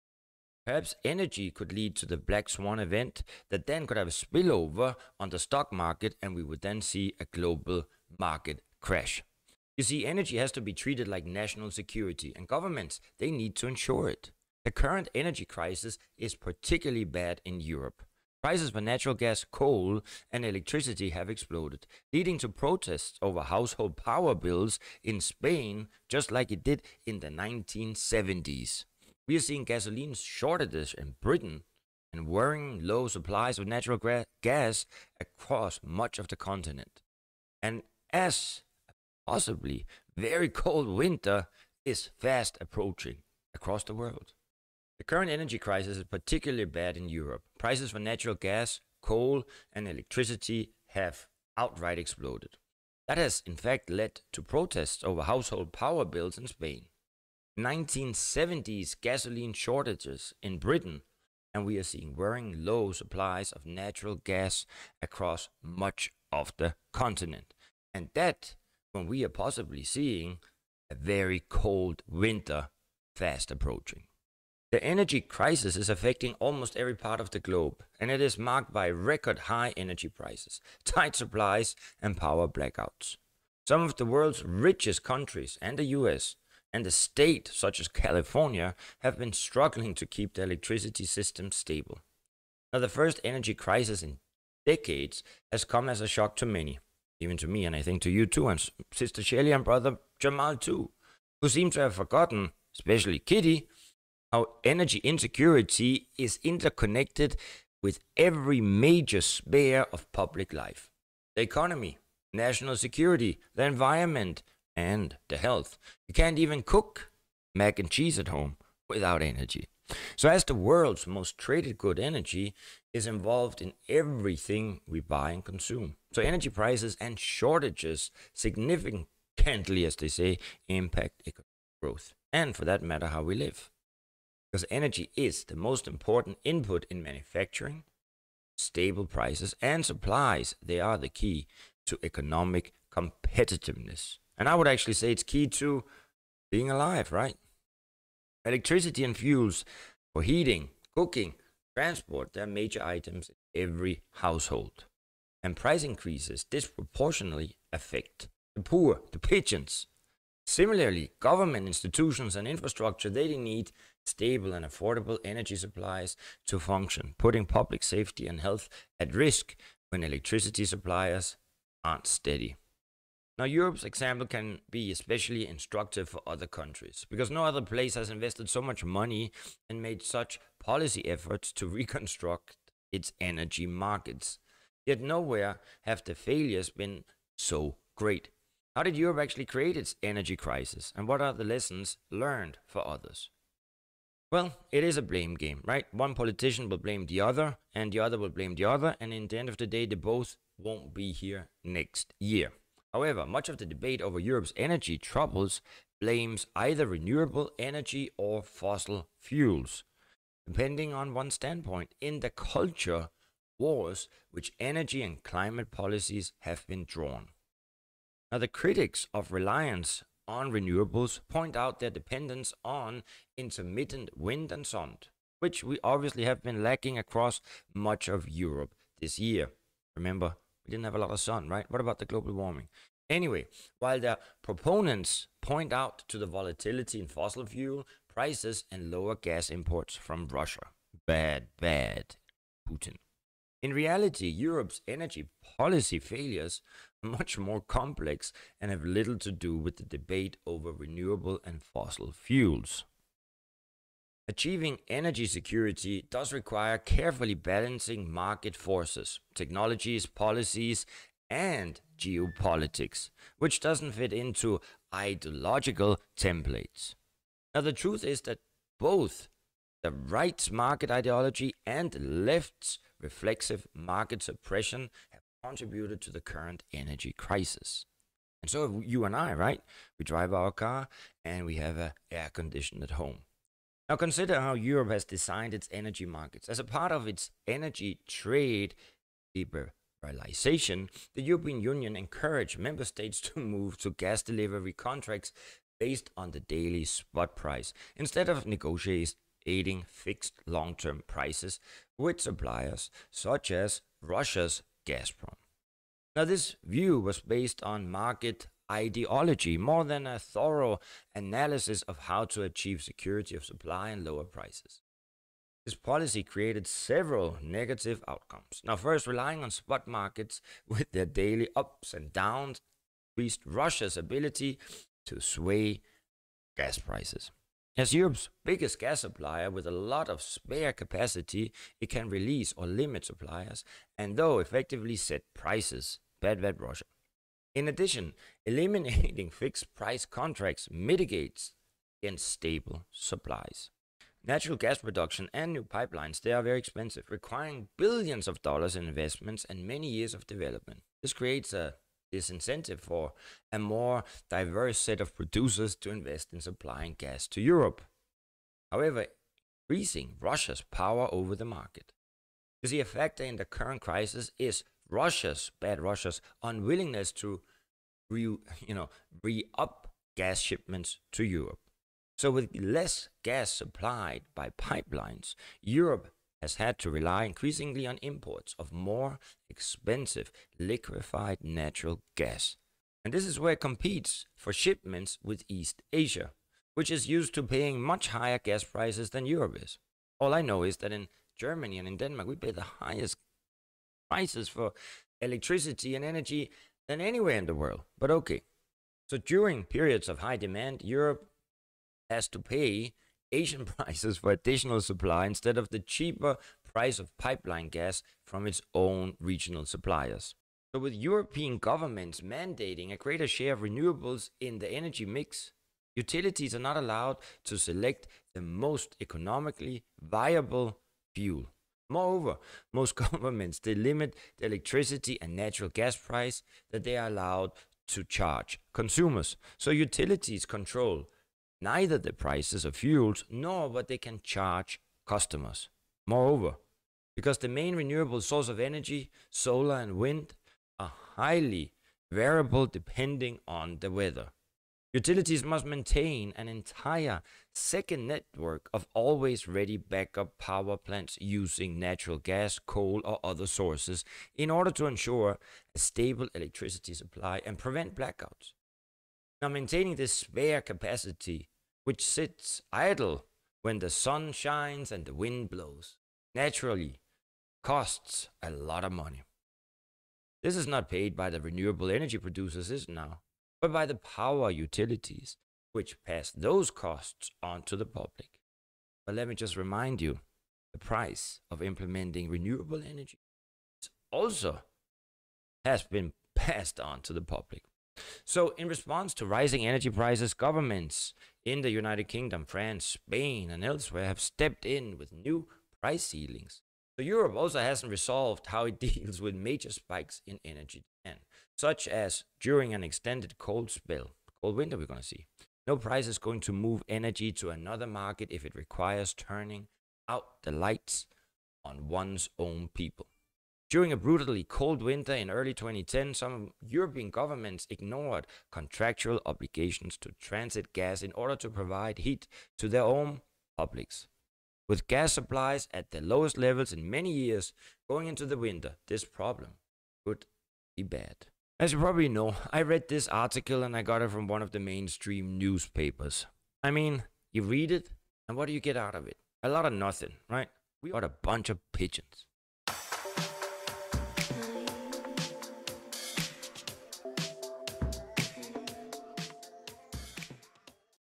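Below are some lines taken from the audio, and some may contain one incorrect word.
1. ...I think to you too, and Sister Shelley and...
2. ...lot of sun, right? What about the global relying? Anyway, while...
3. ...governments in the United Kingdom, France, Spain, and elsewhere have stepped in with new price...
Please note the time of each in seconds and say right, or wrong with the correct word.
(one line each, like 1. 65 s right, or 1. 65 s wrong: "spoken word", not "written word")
1. 97 s right
2. 230 s wrong: "warming", not "relying"
3. 490 s right.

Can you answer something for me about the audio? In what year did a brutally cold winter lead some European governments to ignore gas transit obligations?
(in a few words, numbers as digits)
2010.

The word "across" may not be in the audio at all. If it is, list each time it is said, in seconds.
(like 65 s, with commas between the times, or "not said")
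35 s, 43 s, 65 s, 226 s.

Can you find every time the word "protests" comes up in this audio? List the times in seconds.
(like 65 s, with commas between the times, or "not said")
22 s, 54 s.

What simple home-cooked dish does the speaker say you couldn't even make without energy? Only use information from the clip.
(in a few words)
mac and cheese.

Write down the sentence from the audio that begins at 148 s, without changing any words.
Electricity and fuels for heating, cooking, transport, they're major items in every household.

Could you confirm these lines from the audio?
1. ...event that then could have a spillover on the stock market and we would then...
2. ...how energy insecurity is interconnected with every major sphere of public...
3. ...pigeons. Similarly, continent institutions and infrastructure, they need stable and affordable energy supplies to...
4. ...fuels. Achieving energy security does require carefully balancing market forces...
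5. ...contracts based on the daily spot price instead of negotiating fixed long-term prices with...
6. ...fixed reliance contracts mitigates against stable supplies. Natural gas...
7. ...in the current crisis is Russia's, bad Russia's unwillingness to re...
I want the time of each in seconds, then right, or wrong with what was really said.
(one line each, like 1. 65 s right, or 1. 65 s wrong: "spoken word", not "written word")
1. 2 s right
2. 104 s right
3. 159 s wrong: "government", not "continent"
4. 252 s right
5. 294 s right
6. 339 s wrong: "price", not "reliance"
7. 363 s right.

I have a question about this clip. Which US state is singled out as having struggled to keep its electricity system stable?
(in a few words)
California.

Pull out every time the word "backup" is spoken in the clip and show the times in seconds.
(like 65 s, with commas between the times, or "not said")
449 s.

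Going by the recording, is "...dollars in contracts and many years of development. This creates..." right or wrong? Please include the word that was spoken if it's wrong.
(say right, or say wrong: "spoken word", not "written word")
wrong: "investments", not "contracts".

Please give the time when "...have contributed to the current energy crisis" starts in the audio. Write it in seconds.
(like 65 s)
275 s.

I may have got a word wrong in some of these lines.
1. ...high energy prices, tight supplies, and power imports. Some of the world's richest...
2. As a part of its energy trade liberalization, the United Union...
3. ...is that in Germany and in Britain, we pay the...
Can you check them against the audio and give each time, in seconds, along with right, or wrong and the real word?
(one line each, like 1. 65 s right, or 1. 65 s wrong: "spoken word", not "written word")
1. 79 s wrong: "blackouts", not "imports"
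2. 286 s wrong: "European", not "United"
3. 390 s wrong: "Denmark", not "Britain".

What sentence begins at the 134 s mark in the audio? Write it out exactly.
Because energy is the most important input in manufacturing, stable prices, and supplies.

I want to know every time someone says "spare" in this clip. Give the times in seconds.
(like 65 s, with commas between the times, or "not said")
330 s, 460 s.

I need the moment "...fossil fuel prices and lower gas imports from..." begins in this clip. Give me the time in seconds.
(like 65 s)
237 s.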